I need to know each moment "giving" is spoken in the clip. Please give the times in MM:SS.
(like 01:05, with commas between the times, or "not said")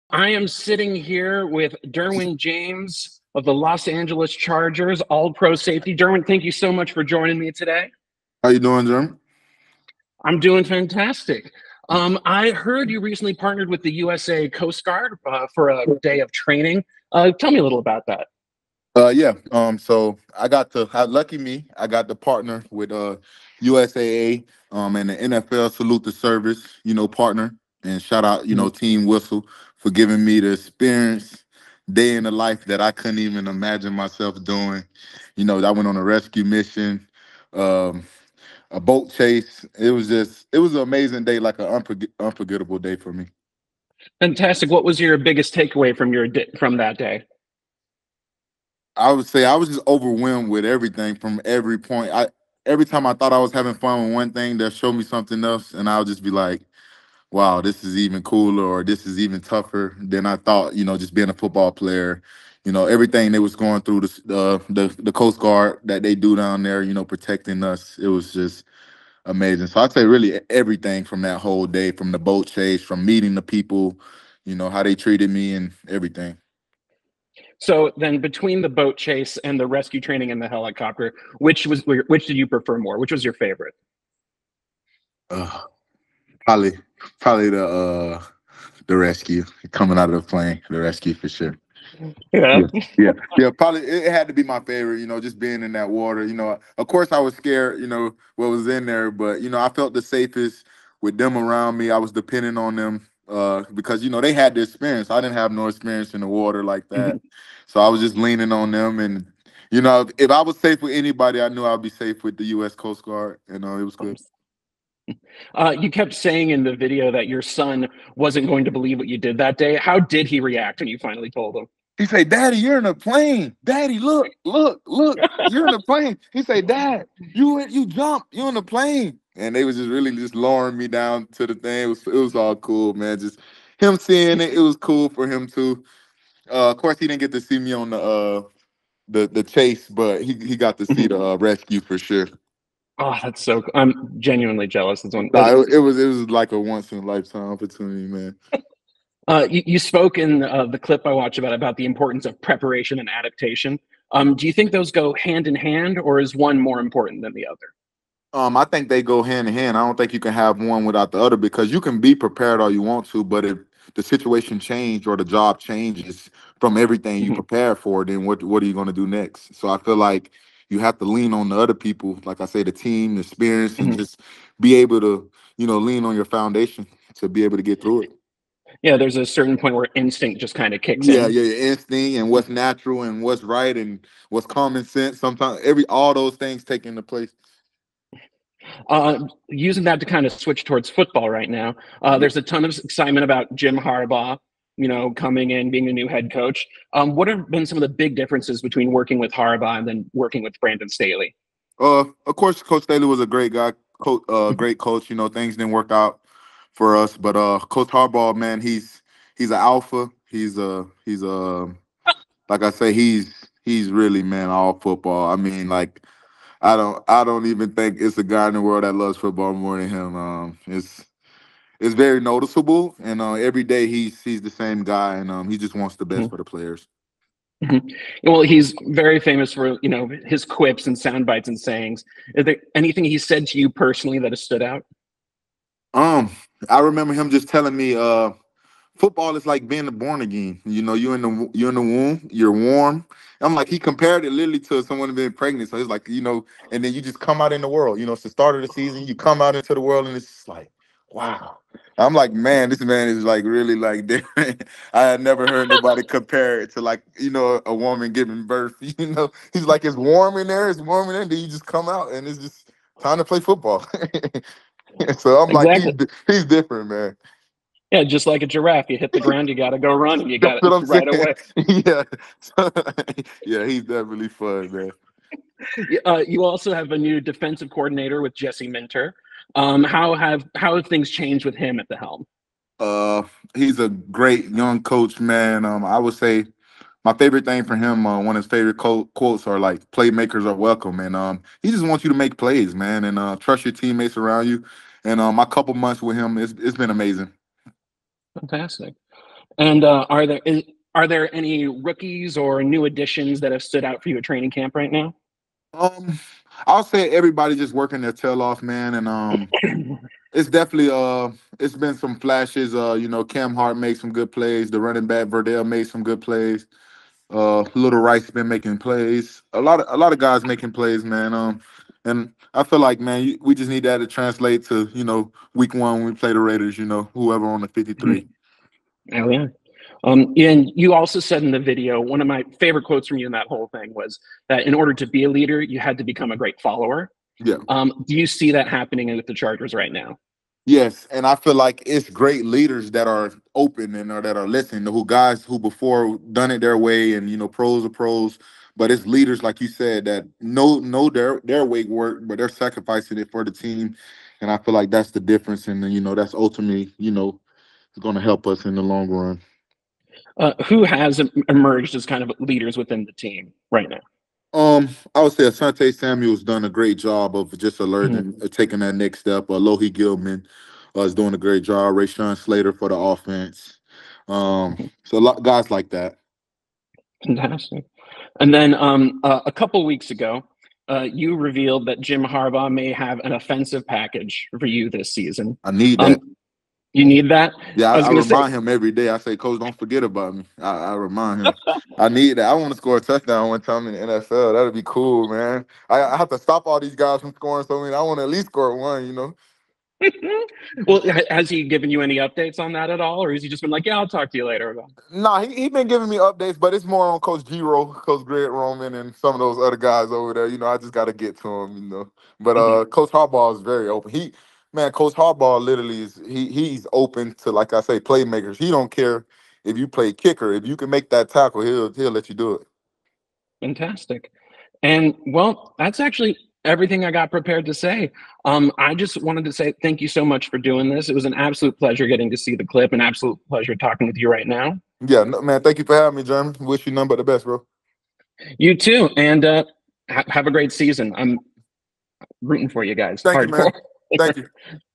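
00:29, 04:18, 06:45.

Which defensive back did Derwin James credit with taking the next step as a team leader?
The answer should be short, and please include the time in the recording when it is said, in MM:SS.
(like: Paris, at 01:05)
Asante Samuel, at 06:05.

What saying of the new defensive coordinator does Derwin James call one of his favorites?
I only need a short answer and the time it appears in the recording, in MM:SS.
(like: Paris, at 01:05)
Playmakers are welcome, at 04:49.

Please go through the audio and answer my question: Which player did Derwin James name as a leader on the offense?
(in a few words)
Rashawn Slater.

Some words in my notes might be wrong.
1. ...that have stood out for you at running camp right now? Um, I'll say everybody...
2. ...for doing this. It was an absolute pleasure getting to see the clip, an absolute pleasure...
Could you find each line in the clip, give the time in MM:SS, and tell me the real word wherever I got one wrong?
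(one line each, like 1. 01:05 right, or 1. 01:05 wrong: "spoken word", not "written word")
1. 05:03 wrong: "training", not "running"
2. 07:10 right.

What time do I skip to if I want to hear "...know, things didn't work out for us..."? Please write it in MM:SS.
03:25.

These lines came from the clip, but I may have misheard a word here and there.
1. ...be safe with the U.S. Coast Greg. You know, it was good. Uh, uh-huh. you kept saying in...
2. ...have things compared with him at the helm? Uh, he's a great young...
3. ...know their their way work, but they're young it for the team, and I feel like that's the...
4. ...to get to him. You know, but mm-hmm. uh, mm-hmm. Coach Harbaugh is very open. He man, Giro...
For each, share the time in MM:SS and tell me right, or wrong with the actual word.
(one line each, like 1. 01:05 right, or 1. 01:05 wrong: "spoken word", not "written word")
1. 01:51 wrong: "Guard", not "Greg"
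2. 04:40 wrong: "changed", not "compared"
3. 05:50 wrong: "sacrificing", not "young"
4. 06:51 wrong: "Coach", not "Giro".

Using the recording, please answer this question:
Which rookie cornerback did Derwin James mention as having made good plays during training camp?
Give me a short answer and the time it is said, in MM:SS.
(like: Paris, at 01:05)
Cam Hart, at 05:13.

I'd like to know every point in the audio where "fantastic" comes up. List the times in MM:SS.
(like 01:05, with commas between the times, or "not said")
00:10, 00:44, 04:58, 06:17, 07:03.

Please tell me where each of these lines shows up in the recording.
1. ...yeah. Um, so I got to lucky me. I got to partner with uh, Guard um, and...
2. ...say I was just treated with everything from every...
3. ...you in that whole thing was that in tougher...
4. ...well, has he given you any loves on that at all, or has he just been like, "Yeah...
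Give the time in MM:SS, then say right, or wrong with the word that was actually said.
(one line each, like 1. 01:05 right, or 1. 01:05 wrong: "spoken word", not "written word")
1. 00:19 wrong: "USAA", not "Guard"
2. 00:49 wrong: "overwhelmed", not "treated"
3. 05:33 wrong: "order", not "tougher"
4. 06:40 wrong: "updates", not "loves".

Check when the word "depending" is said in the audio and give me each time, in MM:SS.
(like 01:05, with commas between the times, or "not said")
01:42.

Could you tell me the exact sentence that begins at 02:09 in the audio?
And they was just really just lowering me down to the thing.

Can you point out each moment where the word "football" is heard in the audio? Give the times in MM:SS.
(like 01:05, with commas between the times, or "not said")
01:01, 03:10, 03:34, 03:39, 03:58, 04:23.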